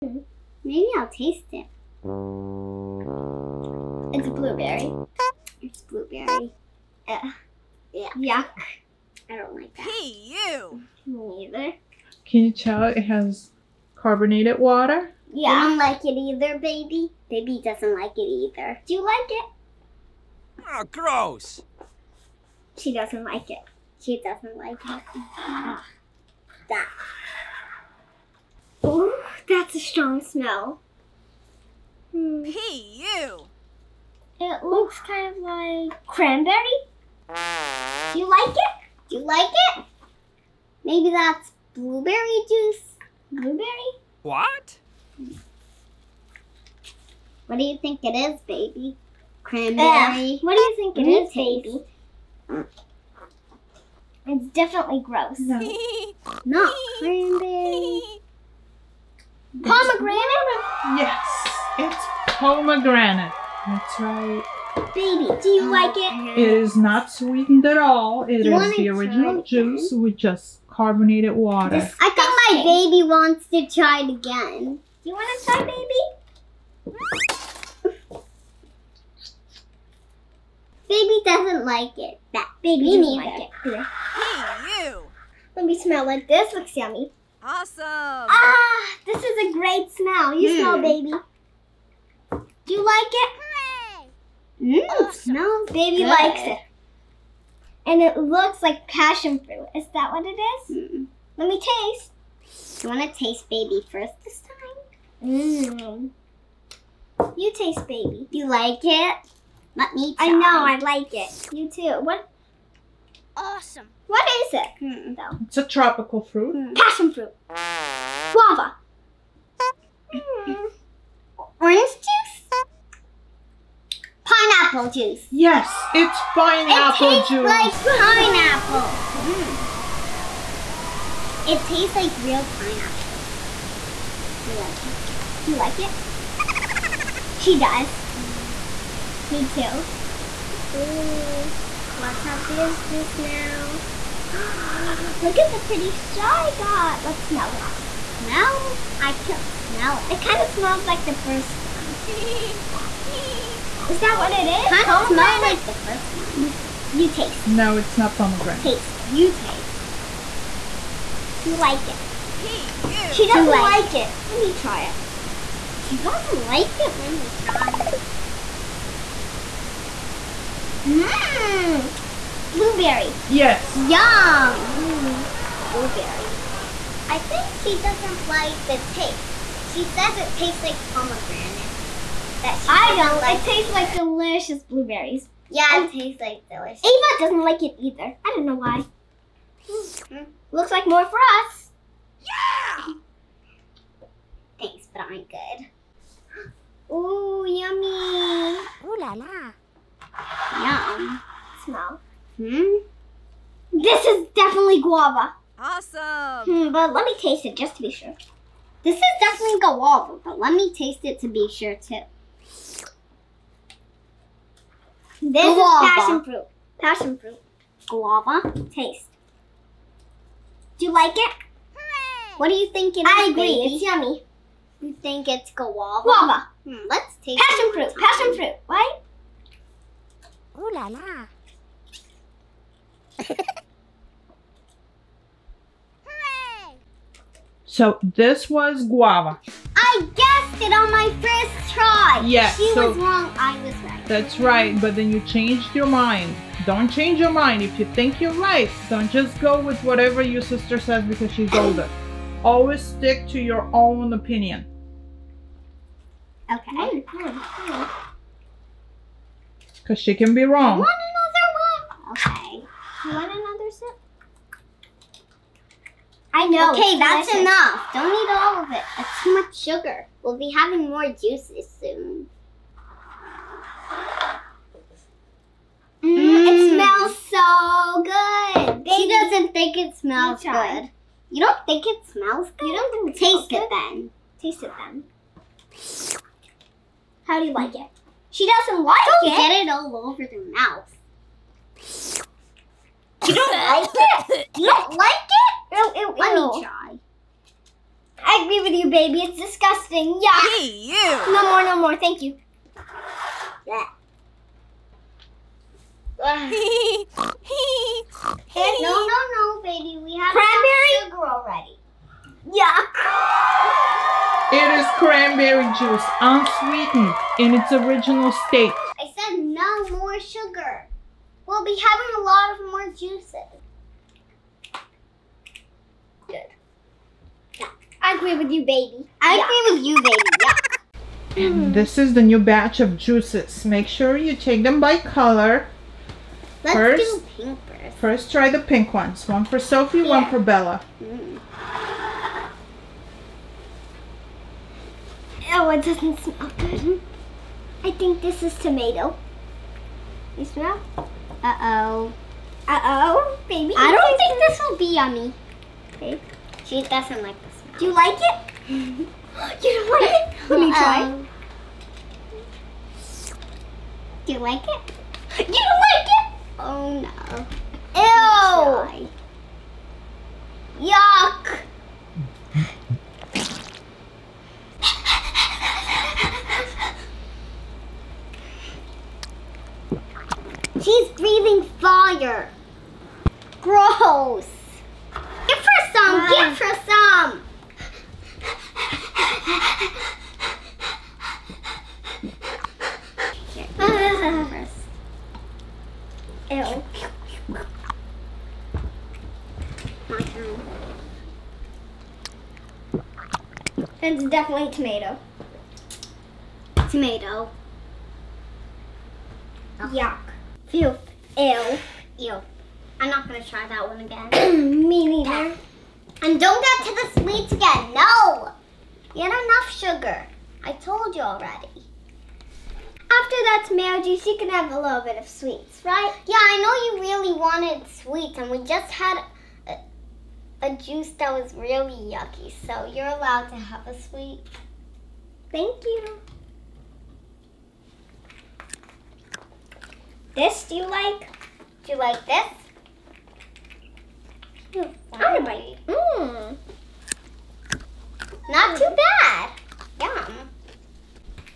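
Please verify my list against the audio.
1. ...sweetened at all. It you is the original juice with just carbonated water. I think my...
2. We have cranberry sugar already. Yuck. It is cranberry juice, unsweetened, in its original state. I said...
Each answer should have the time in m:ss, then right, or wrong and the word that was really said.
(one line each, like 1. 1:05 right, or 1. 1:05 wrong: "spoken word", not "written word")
1. 1:07 right
2. 5:10 right.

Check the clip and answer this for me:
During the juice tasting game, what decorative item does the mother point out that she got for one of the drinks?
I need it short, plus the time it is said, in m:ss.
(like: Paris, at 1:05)
pretty straw, at 2:25.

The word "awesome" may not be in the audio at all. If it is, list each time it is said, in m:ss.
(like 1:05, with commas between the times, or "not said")
1:27, 1:34, 1:53, 3:25.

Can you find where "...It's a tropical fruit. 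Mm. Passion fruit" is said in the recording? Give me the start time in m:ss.
1:55.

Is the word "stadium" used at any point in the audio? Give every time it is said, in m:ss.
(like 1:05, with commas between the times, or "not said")
not said.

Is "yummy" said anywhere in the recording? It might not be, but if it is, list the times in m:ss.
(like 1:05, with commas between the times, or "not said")
1:26, 3:17, 3:43, 5:54.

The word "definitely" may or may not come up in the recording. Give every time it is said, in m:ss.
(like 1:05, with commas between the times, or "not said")
0:54, 3:24, 3:29, 6:44.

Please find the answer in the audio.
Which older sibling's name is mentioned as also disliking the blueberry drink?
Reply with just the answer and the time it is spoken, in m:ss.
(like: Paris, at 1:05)
Ava, at 3:06.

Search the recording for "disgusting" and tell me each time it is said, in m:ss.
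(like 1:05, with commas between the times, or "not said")
4:59.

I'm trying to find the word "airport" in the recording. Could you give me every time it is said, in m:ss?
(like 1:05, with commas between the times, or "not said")
not said.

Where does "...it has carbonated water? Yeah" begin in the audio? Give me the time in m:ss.
0:12.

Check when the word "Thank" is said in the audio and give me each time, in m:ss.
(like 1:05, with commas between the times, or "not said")
3:14, 5:01, 7:15.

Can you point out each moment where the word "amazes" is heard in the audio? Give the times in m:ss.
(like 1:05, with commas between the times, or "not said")
not said.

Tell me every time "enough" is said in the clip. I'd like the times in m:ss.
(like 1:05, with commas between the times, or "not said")
4:27, 6:59.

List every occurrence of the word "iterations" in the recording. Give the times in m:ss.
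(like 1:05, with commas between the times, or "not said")
not said.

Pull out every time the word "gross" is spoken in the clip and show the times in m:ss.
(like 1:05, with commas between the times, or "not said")
0:20, 0:55.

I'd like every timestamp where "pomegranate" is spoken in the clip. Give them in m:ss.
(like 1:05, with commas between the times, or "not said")
1:02, 2:38, 3:00.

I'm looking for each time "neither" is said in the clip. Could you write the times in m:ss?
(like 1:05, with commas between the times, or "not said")
0:11, 6:55.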